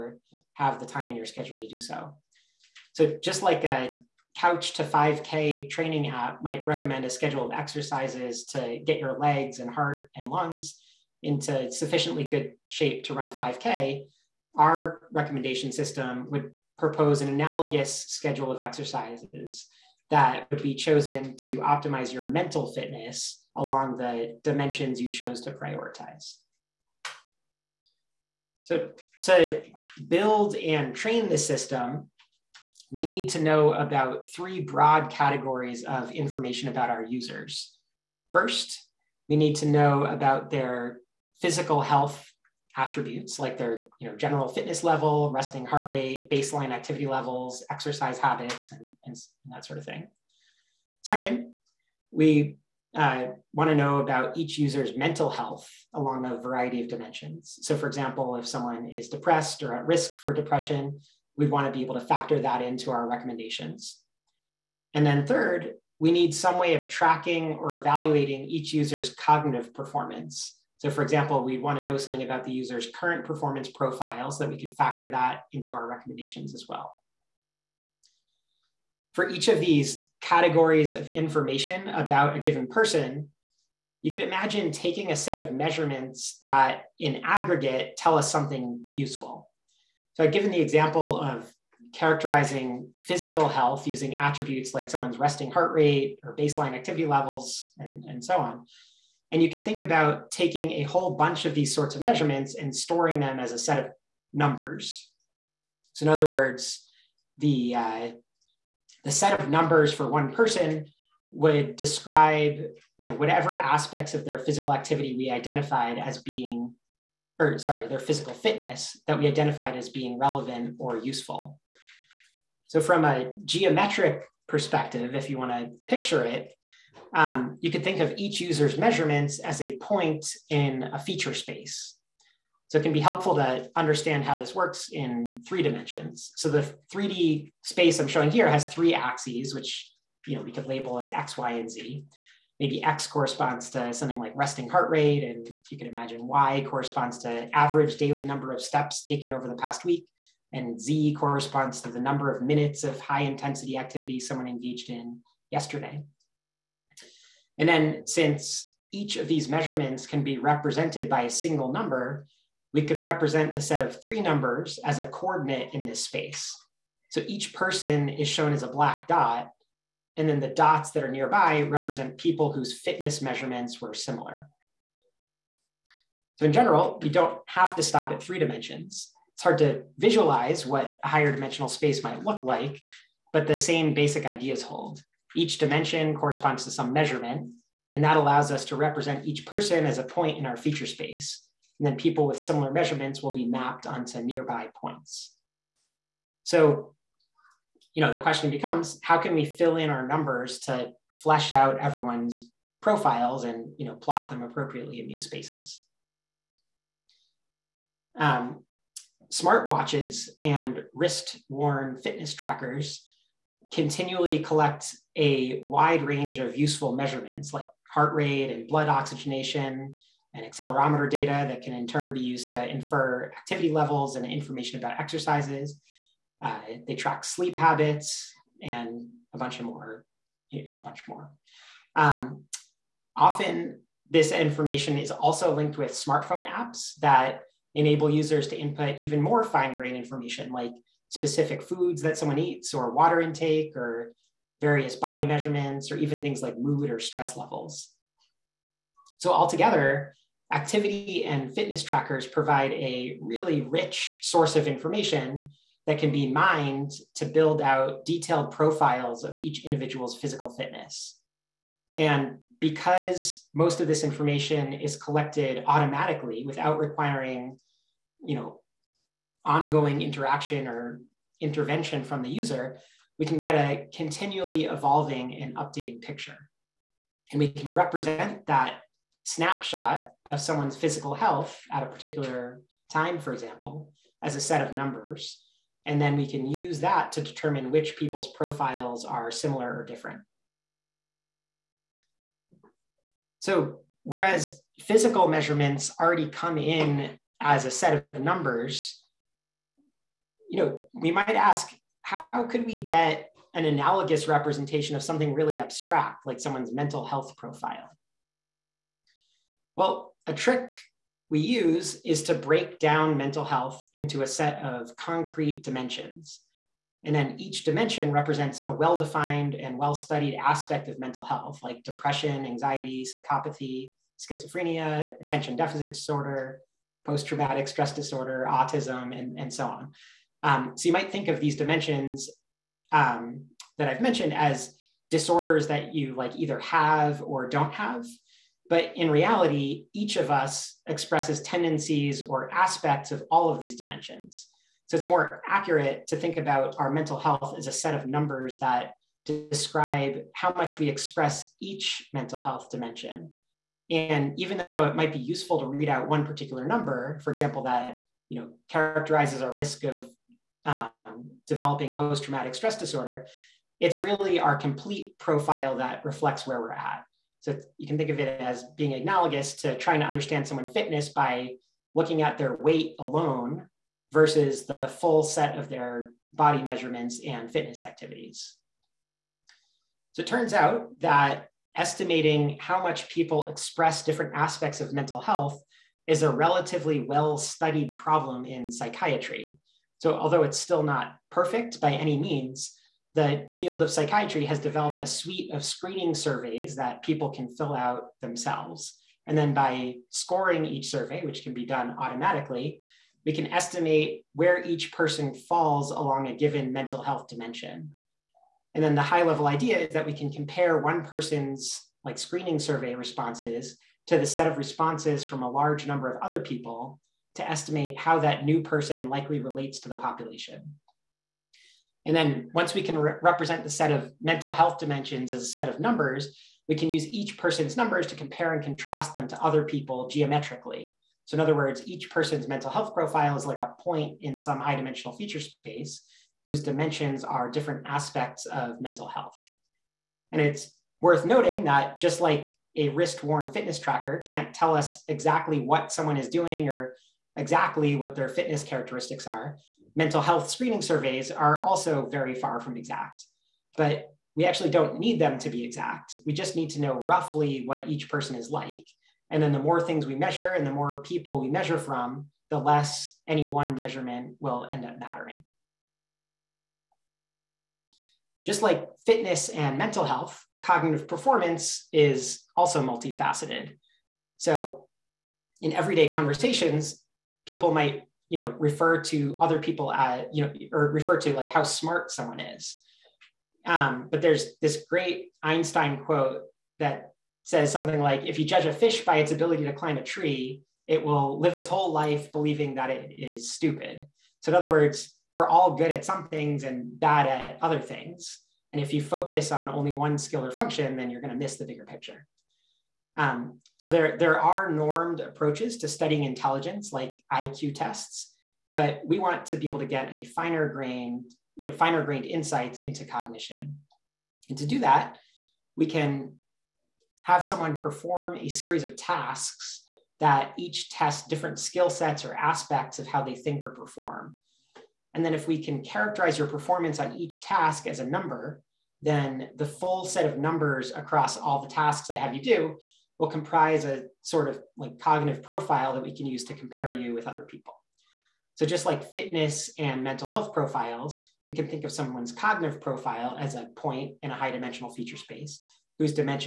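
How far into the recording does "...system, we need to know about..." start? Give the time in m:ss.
0:31.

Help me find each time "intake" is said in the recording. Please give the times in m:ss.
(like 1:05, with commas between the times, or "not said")
4:03.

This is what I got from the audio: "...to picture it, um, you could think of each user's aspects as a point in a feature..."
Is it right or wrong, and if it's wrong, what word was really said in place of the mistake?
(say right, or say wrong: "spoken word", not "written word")
wrong: "measurements", not "aspects".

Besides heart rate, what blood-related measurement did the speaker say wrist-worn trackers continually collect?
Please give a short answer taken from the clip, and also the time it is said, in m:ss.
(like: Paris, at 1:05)
blood oxygenation, at 3:38.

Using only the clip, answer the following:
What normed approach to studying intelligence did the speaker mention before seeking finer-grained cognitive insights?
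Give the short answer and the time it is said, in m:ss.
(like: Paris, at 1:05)
IQ tests, at 8:27.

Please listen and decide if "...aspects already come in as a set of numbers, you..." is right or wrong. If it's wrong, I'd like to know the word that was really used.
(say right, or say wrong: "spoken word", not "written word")
wrong: "measurements", not "aspects".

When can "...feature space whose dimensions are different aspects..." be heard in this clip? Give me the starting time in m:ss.
7:15.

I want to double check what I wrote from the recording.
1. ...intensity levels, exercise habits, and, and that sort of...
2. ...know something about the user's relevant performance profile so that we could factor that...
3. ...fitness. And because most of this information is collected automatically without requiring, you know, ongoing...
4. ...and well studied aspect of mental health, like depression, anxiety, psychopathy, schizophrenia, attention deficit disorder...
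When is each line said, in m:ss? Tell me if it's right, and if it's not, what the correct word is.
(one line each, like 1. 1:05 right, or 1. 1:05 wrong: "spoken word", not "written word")
1. 0:46 wrong: "activity", not "intensity"
2. 1:11 wrong: "current", not "relevant"
3. 4:20 right
4. 5:19 right.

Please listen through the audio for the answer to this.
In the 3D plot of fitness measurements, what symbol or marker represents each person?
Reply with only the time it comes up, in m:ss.
2:48.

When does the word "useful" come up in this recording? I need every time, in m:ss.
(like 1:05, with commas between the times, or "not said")
1:28, 2:00, 3:36, 5:55.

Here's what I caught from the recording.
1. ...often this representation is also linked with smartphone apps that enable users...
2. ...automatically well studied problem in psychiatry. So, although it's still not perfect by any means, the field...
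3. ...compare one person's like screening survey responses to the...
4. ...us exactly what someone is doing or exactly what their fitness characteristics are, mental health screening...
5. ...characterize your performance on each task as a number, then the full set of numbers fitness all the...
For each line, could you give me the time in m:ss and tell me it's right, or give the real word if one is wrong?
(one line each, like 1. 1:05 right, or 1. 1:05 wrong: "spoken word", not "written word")
1. 3:53 wrong: "information", not "representation"
2. 6:26 wrong: "relatively", not "automatically"
3. 6:50 right
4. 7:24 right
5. 8:45 wrong: "across", not "fitness".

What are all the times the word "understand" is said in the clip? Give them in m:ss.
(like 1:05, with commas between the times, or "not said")
2:13, 6:10.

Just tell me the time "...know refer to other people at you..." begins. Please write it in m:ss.
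7:58.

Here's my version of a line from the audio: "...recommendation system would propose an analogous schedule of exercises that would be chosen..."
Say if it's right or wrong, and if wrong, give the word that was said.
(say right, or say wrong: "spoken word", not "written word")
right.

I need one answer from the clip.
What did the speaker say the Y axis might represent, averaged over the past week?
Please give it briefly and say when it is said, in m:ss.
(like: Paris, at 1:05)
daily number of steps, at 2:27.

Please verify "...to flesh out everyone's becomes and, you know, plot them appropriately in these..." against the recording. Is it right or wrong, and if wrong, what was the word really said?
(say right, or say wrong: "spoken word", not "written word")
wrong: "profiles", not "becomes".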